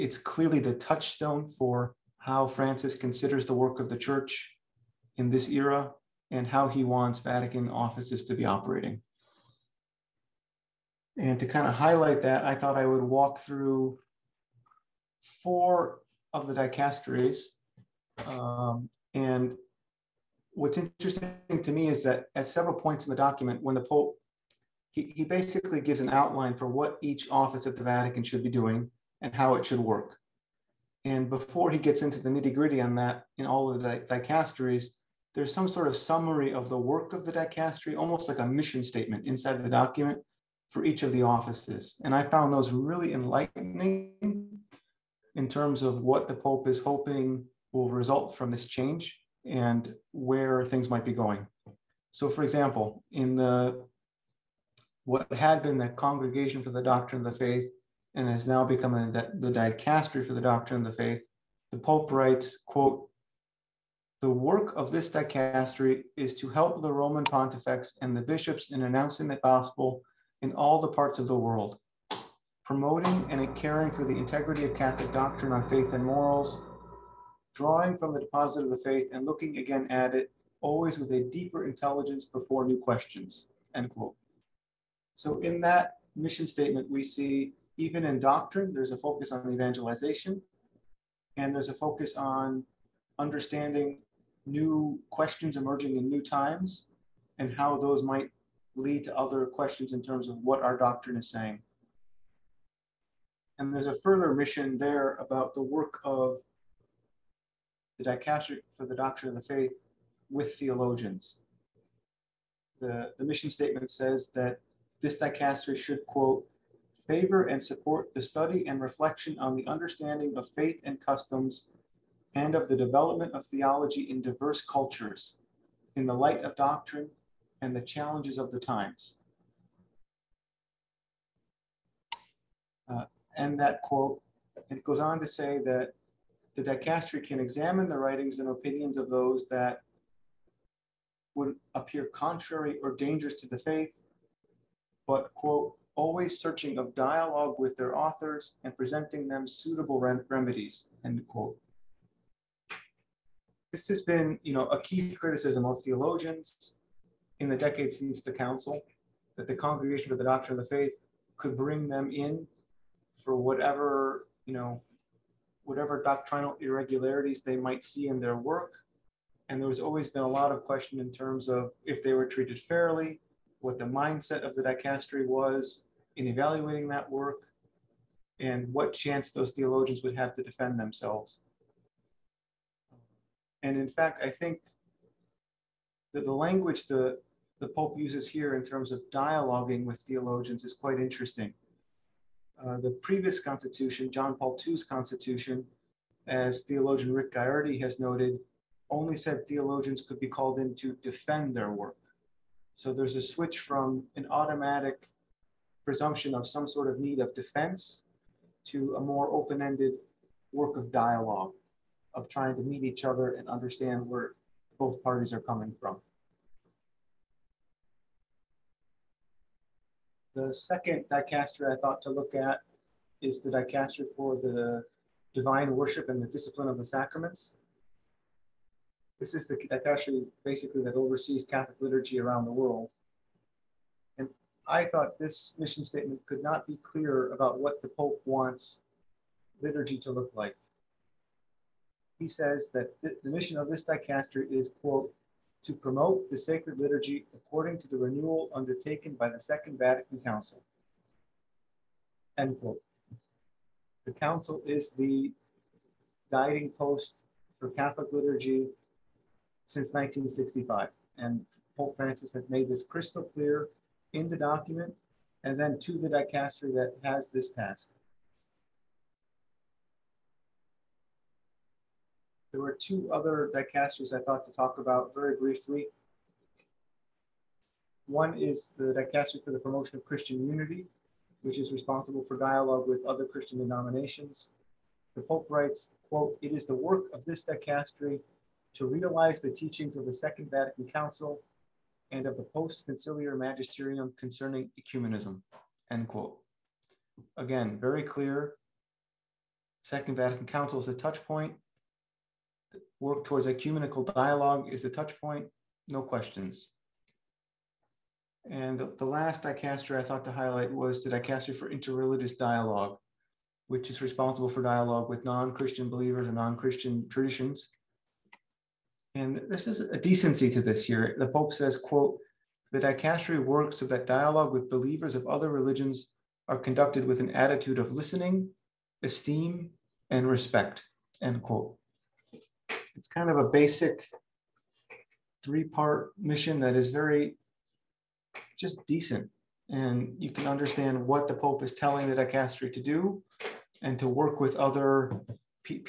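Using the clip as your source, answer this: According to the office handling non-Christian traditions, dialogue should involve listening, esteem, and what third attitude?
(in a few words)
respect.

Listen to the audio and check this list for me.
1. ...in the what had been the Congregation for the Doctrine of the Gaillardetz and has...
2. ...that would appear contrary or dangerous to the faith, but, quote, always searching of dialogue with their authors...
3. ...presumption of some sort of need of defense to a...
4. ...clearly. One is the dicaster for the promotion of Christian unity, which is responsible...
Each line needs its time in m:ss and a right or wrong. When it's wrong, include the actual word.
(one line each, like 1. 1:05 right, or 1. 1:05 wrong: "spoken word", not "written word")
1. 0:53 wrong: "Faith", not "Gaillardetz"
2. 2:19 right
3. 3:25 right
4. 4:35 wrong: "briefly", not "clearly".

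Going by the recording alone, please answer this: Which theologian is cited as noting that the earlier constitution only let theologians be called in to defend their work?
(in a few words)
Rick Gaillardetz.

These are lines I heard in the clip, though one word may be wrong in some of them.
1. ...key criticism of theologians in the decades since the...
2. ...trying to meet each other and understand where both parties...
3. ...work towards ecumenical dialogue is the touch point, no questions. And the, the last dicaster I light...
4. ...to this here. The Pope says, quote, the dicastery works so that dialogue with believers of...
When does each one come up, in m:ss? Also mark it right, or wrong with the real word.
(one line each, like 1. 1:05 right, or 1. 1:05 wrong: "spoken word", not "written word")
1. 2:34 right
2. 3:32 right
3. 5:03 wrong: "thought", not "light"
4. 5:20 right.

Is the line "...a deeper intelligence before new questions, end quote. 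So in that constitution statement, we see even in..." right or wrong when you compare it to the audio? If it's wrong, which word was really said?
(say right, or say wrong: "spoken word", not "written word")
wrong: "mission", not "constitution".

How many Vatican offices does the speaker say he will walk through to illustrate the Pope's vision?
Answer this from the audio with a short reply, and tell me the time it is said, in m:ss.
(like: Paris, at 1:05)
4, at 0:15.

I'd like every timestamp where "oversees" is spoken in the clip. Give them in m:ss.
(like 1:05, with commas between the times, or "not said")
3:50.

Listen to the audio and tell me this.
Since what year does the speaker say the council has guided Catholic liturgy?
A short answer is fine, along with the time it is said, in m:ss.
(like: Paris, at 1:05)
1965, at 4:19.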